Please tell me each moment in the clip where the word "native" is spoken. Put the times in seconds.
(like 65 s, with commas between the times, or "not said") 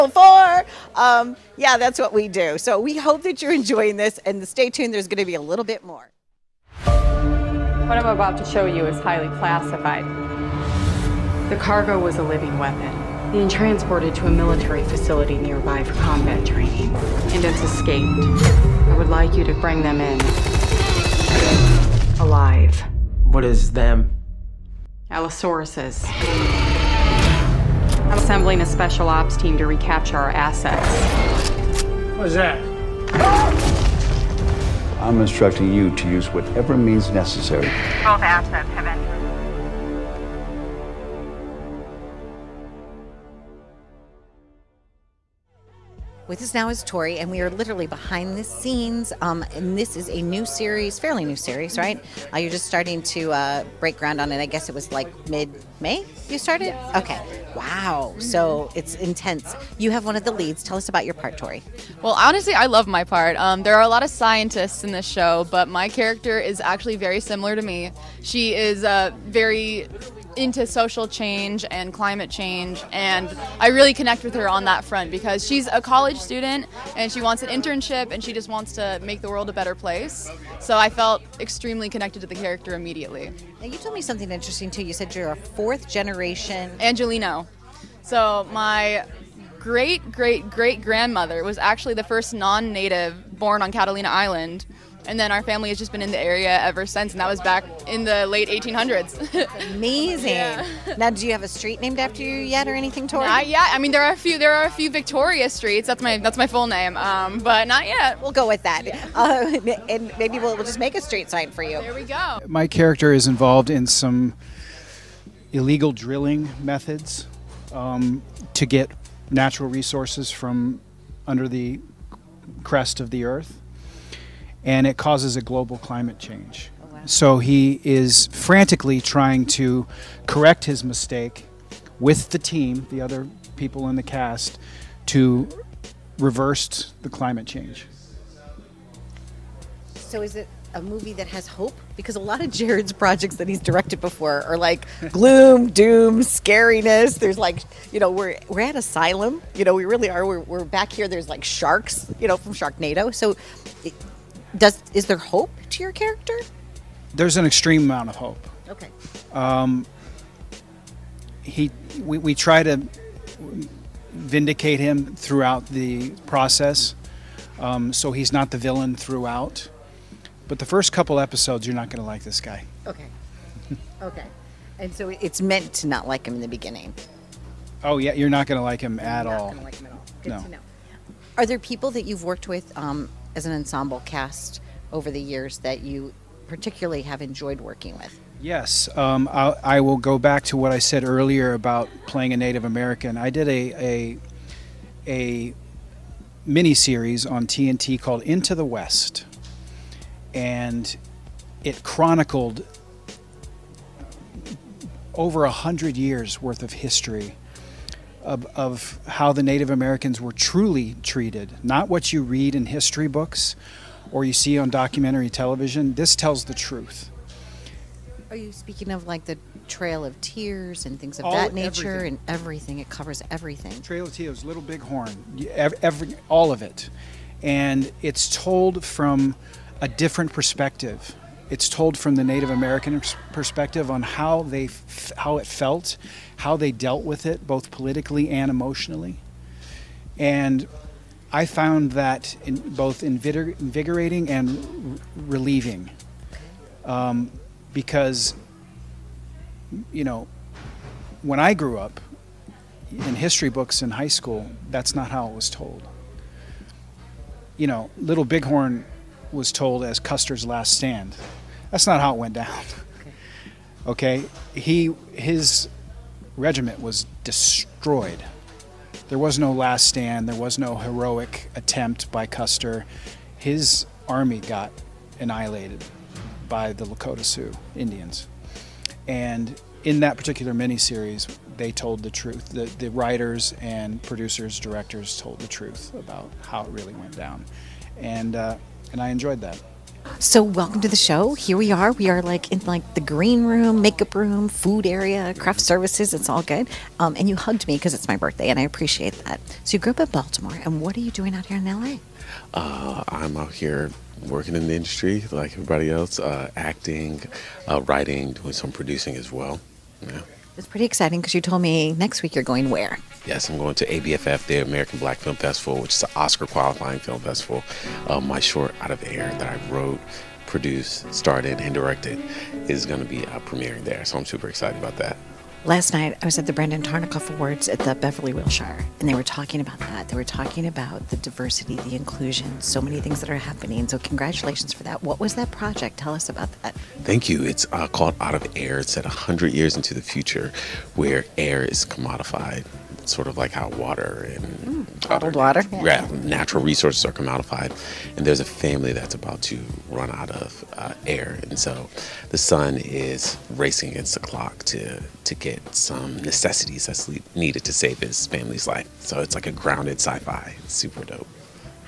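92 s, 192 s, 209 s, 232 s.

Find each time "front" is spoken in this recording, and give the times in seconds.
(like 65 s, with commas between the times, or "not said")
74 s.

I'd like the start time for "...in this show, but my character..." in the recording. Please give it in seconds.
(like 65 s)
64 s.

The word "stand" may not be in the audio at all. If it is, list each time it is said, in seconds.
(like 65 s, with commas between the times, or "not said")
260 s, 269 s.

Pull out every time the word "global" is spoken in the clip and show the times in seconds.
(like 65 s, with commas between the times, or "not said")
125 s.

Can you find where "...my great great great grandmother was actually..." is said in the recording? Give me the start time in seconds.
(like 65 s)
88 s.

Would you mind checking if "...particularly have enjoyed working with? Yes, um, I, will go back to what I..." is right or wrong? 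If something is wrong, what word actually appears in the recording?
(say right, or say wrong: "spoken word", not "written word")
right.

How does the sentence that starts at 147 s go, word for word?
There's like, you know, we're we're at asylum.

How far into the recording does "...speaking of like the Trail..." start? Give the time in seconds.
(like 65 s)
218 s.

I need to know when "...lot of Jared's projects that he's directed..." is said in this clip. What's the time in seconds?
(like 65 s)
142 s.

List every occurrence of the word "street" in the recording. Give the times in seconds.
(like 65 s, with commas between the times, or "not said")
101 s, 105 s, 111 s.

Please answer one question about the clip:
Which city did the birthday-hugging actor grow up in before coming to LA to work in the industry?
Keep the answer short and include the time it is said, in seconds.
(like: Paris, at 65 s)
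Baltimore, at 300 s.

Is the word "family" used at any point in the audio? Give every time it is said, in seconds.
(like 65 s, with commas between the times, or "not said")
95 s, 348 s, 358 s.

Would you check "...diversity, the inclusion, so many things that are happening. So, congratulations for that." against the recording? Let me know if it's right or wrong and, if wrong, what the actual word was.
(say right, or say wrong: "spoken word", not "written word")
right.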